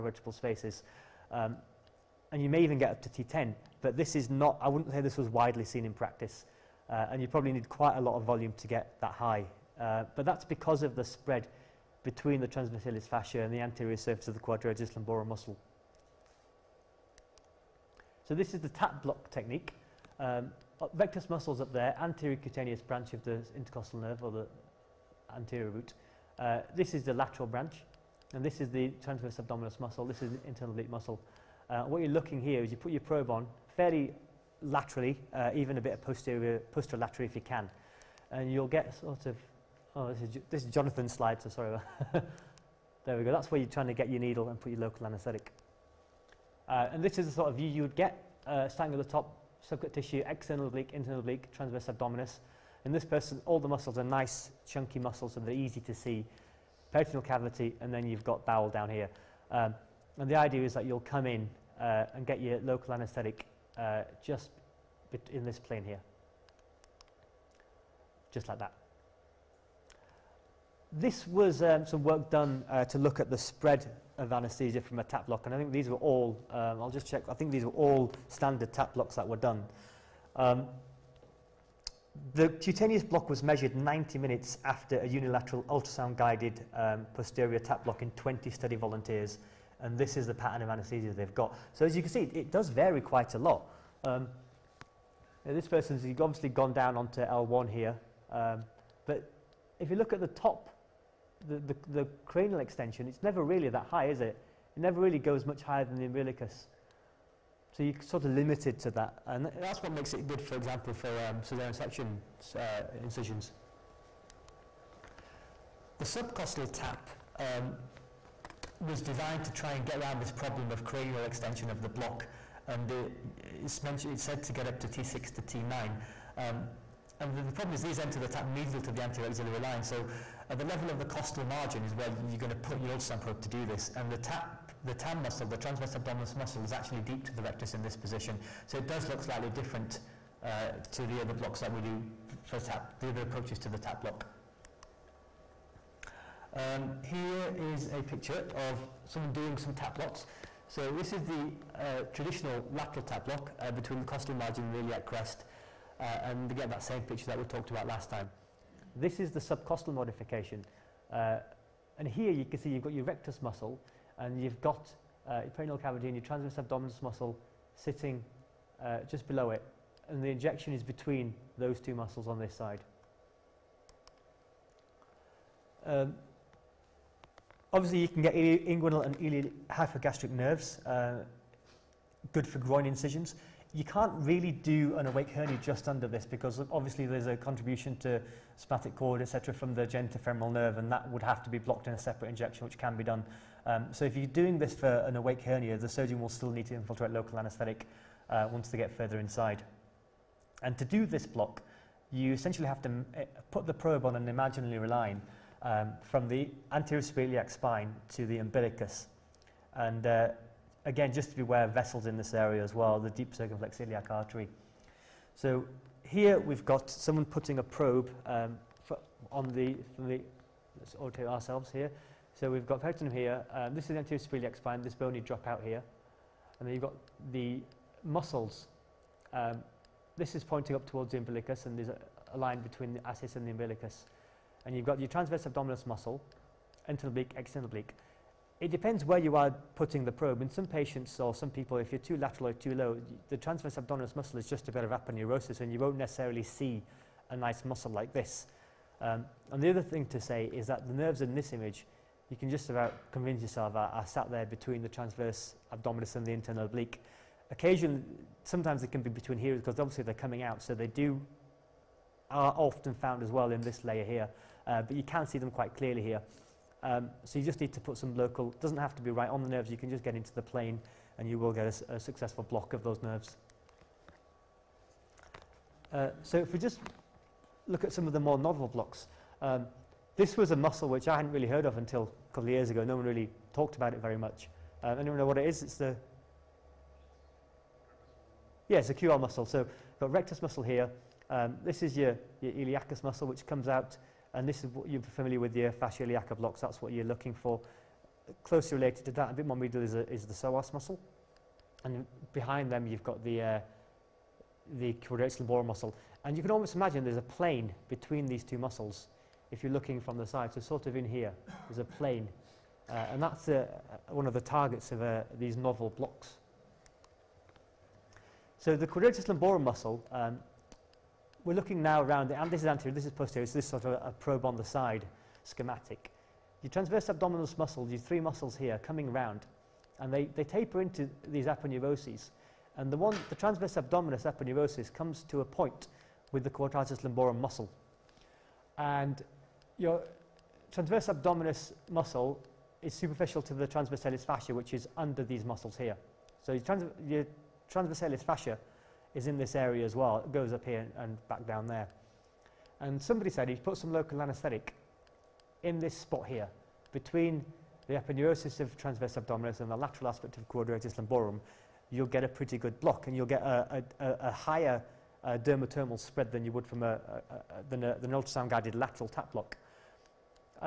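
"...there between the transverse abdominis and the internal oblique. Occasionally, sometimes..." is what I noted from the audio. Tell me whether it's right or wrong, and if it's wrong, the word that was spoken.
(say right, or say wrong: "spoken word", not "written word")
right.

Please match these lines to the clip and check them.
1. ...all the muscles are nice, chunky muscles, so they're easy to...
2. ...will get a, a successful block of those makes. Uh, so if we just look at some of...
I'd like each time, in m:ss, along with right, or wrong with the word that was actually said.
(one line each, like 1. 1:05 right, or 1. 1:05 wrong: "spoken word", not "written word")
1. 0:53 right
2. 4:31 wrong: "nerves", not "makes".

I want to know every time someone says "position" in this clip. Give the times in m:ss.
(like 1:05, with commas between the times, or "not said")
2:17.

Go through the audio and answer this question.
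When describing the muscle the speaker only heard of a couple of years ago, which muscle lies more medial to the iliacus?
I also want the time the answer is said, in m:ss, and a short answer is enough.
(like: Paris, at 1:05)
Psoas muscle, at 5:00.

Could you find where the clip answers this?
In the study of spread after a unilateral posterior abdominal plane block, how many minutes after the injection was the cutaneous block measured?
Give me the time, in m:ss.
1:23.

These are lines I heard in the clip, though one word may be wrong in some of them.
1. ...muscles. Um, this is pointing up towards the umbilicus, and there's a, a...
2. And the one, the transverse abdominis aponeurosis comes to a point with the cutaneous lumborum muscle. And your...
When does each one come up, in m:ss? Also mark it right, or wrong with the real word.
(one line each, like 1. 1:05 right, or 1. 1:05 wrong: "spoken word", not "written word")
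1. 3:48 right
2. 5:32 wrong: "quadratus", not "cutaneous".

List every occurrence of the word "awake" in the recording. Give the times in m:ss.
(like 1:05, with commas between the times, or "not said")
3:05, 3:15.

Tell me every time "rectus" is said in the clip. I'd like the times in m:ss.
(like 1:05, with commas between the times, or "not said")
0:20, 2:17, 2:43, 4:50.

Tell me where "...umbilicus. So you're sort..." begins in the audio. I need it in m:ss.
1:46.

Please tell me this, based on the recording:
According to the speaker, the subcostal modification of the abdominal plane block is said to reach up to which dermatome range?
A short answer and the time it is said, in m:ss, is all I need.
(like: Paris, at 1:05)
T6 to T9, at 2:04.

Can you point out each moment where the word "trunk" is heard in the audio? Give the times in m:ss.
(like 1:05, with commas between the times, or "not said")
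not said.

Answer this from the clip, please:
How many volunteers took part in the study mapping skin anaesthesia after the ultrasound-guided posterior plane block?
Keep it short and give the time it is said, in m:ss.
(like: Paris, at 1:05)
20, at 1:28.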